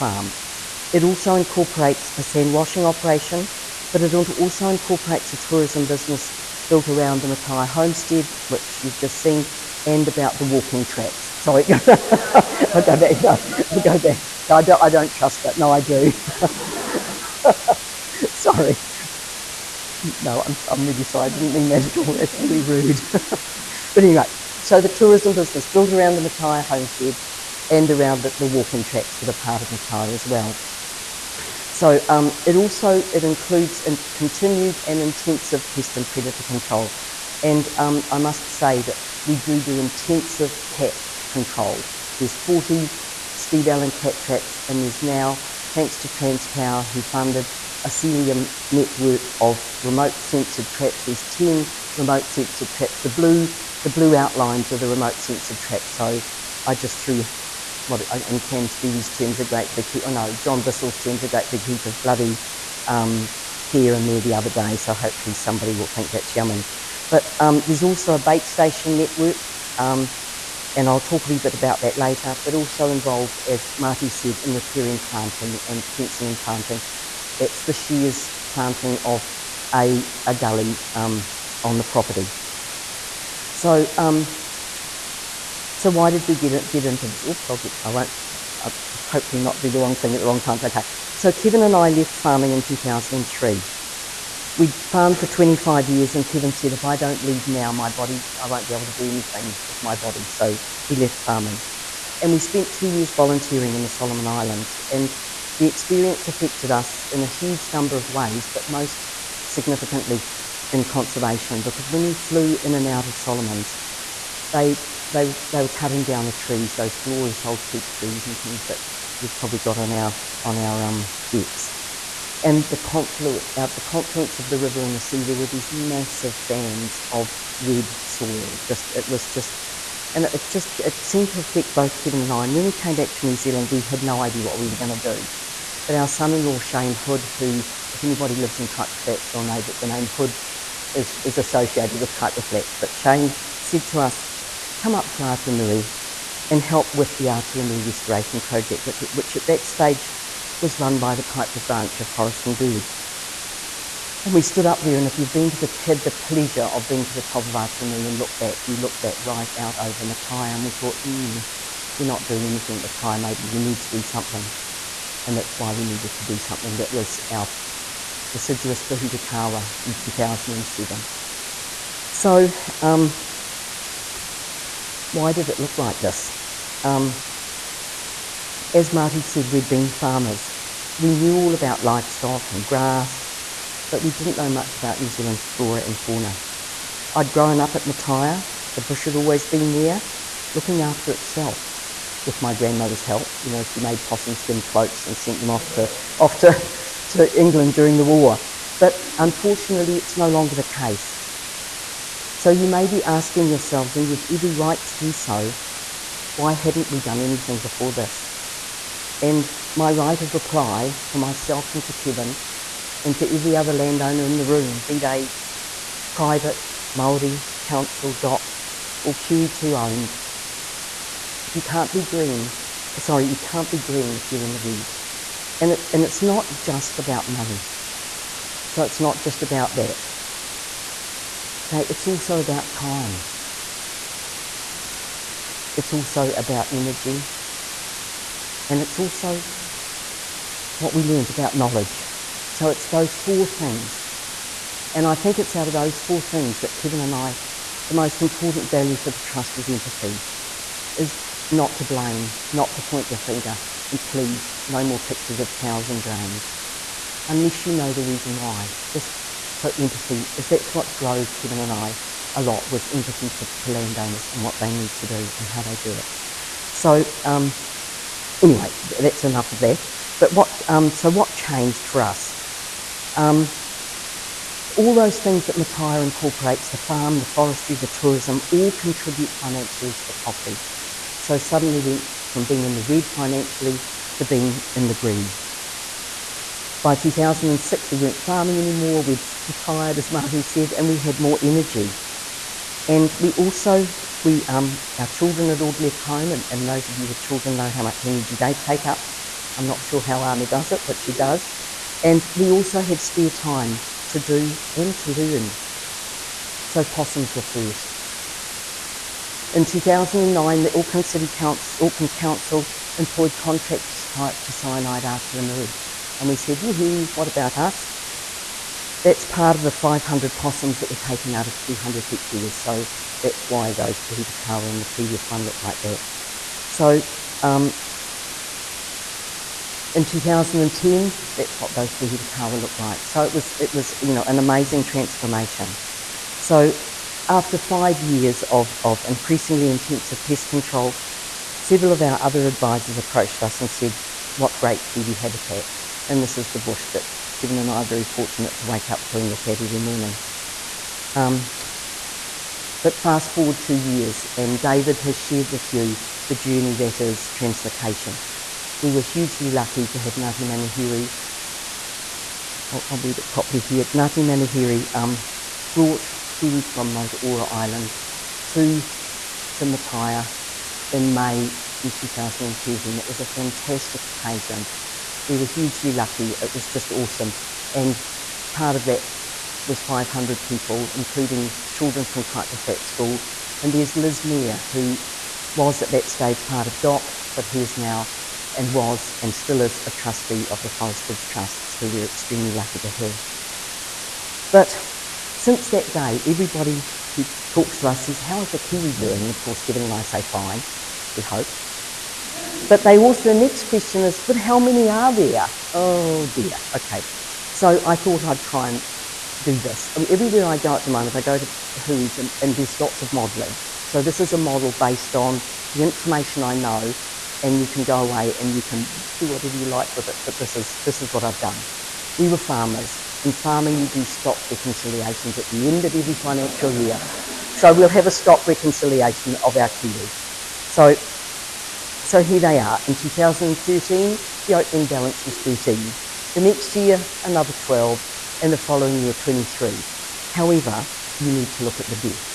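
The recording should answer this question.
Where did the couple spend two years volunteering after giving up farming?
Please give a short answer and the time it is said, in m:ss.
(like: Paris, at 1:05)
Solomon Islands, at 1:43.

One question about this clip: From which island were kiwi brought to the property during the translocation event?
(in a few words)
Motuora Island.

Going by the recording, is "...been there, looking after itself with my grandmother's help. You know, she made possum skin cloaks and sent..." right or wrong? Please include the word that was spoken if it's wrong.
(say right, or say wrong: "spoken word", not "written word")
right.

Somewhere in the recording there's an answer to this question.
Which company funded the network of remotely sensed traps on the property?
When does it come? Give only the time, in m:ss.
0:46.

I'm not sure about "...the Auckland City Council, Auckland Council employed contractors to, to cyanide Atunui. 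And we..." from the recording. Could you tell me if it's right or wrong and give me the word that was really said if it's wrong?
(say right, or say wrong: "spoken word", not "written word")
right.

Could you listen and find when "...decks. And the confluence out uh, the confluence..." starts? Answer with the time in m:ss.
2:01.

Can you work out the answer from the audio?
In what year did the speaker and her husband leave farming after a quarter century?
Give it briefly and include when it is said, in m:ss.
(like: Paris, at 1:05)
2003, at 1:32.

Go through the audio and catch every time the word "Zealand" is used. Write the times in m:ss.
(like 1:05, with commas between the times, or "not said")
2:13, 3:05.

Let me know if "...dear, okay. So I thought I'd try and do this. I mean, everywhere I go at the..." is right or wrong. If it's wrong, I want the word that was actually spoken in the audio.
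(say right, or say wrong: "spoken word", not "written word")
right.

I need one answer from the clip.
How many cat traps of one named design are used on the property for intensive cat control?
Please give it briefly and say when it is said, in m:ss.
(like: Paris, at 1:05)
40, at 0:42.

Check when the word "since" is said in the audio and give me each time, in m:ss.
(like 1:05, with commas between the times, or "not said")
6:35.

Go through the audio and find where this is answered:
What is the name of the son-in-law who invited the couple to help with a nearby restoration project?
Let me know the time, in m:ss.
2:16.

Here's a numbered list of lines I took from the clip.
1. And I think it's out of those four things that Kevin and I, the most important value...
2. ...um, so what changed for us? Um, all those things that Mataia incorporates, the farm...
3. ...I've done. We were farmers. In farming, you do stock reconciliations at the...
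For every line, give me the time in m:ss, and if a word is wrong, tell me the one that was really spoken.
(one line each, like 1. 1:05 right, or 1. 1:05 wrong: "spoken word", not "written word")
1. 4:04 right
2. 4:30 right
3. 7:01 right.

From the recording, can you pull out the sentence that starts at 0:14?
So I don't, I don't trust it.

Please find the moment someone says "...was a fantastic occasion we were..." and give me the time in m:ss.
6:13.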